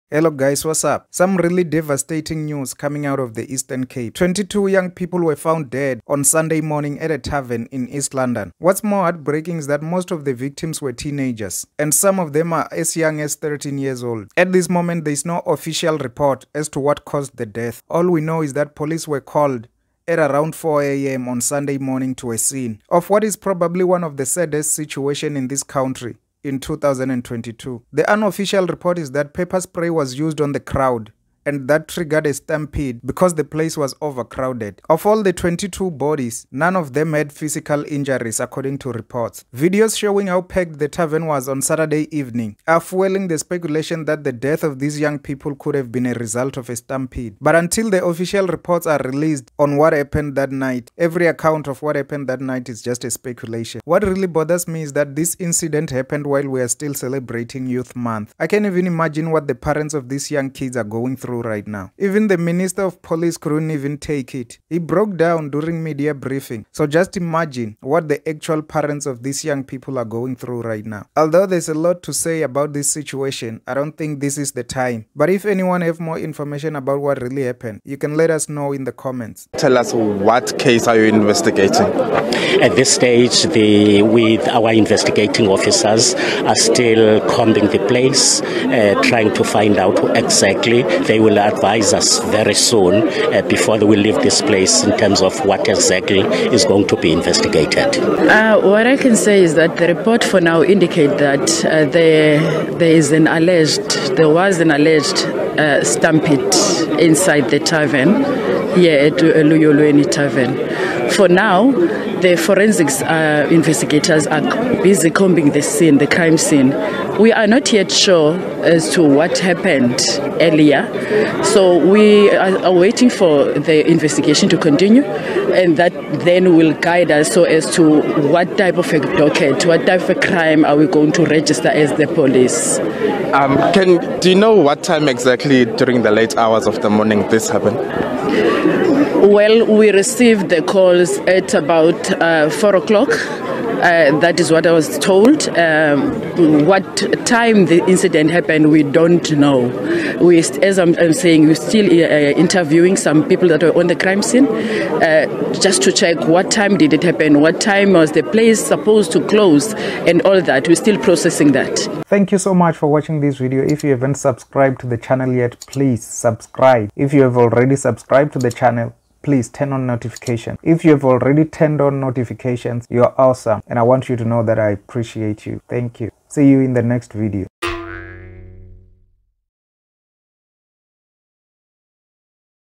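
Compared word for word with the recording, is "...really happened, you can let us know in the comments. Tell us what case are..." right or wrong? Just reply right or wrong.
right.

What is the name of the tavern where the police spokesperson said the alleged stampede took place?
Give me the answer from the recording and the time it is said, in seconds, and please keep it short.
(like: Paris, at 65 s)
Luyolweni Tavern, at 109 s.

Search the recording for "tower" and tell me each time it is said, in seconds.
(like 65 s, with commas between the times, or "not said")
not said.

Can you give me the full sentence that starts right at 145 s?
Um, what time the incident happened, we don't know.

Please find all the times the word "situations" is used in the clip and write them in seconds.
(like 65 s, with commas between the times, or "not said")
24 s, 72 s.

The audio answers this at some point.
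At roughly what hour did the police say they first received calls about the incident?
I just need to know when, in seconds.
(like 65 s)
142 s.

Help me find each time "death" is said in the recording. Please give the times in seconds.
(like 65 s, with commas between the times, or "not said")
17 s, 44 s.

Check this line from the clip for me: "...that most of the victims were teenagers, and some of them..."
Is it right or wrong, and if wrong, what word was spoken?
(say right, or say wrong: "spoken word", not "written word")
right.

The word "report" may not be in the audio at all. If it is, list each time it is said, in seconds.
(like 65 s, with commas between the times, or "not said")
15 s, 28 s, 38 s, 48 s, 99 s.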